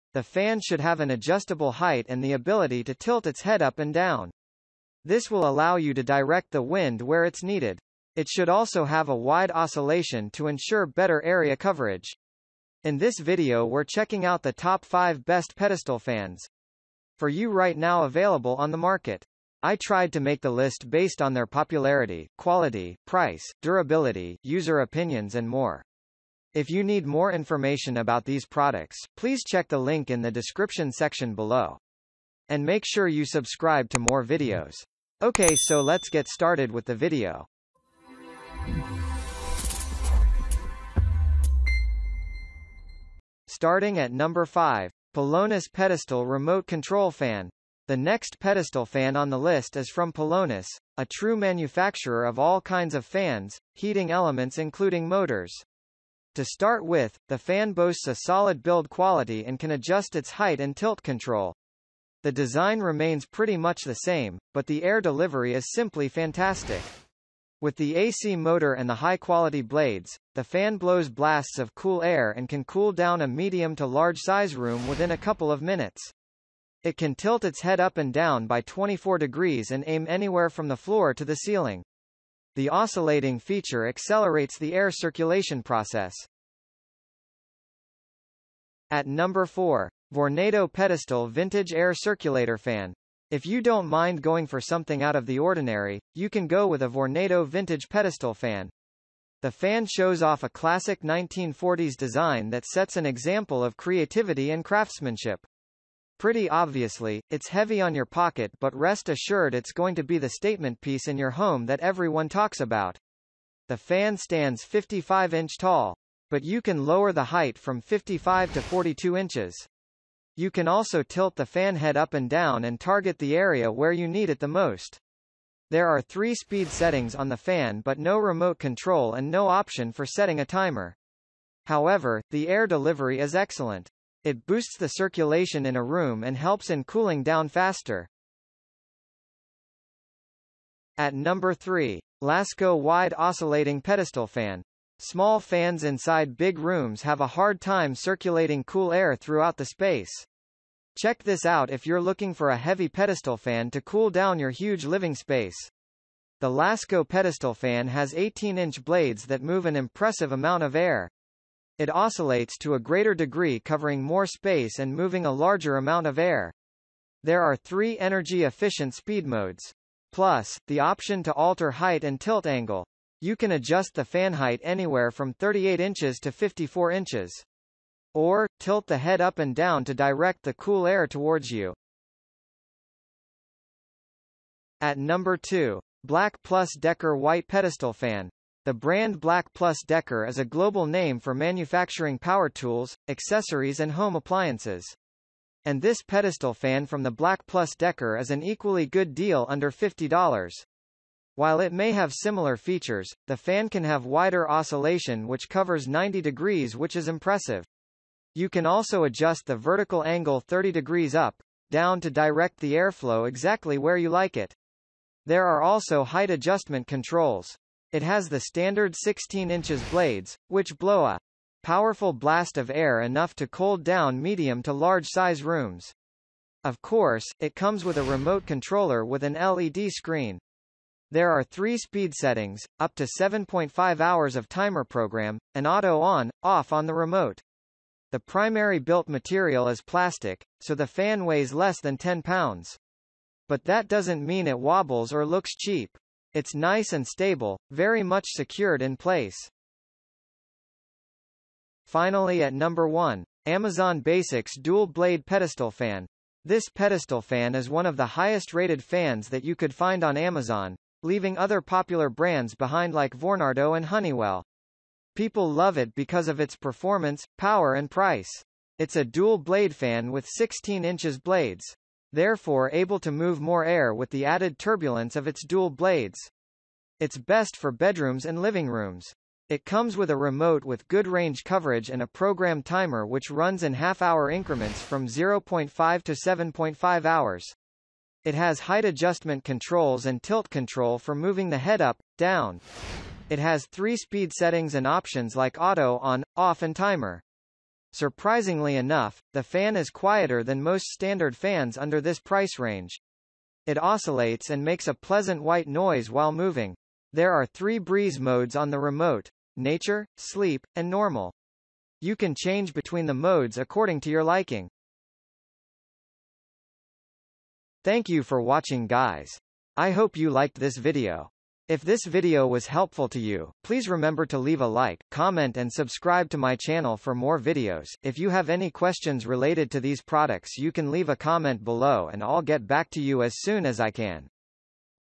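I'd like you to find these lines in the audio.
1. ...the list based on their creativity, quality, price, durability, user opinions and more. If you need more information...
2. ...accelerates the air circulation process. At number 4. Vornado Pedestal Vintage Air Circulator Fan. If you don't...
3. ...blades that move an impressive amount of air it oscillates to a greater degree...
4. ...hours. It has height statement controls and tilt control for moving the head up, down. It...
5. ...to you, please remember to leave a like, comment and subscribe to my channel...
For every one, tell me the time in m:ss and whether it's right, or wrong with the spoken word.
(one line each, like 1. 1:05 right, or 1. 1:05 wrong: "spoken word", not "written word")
1. 0:20 wrong: "popularity", not "creativity"
2. 1:23 right
3. 2:38 right
4. 4:47 wrong: "adjustment", not "statement"
5. 5:23 right.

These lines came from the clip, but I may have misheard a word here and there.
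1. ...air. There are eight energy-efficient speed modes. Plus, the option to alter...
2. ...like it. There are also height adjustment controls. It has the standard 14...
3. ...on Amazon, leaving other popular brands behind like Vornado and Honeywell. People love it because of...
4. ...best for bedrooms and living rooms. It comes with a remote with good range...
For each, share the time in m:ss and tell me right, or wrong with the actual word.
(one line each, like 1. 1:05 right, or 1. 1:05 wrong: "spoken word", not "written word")
1. 2:46 wrong: "three", not "eight"
2. 3:34 wrong: "16", not "14"
3. 4:20 right
4. 4:37 right.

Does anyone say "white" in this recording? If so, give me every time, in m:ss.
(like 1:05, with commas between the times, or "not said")
3:07, 5:05.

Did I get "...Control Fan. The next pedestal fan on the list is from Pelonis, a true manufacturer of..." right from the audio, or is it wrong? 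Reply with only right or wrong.
right.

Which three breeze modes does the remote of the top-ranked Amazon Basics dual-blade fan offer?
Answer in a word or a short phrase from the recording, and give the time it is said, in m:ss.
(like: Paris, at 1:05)
Nature, sleep, and normal, at 5:09.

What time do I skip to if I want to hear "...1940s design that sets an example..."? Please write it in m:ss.
1:41.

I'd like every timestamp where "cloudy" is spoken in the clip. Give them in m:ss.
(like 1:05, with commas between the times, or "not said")
not said.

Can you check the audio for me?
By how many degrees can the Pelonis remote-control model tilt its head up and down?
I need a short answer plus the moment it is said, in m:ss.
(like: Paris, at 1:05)
24 degrees, at 1:18.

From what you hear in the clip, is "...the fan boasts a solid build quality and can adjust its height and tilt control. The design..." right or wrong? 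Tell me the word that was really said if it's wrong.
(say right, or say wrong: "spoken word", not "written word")
right.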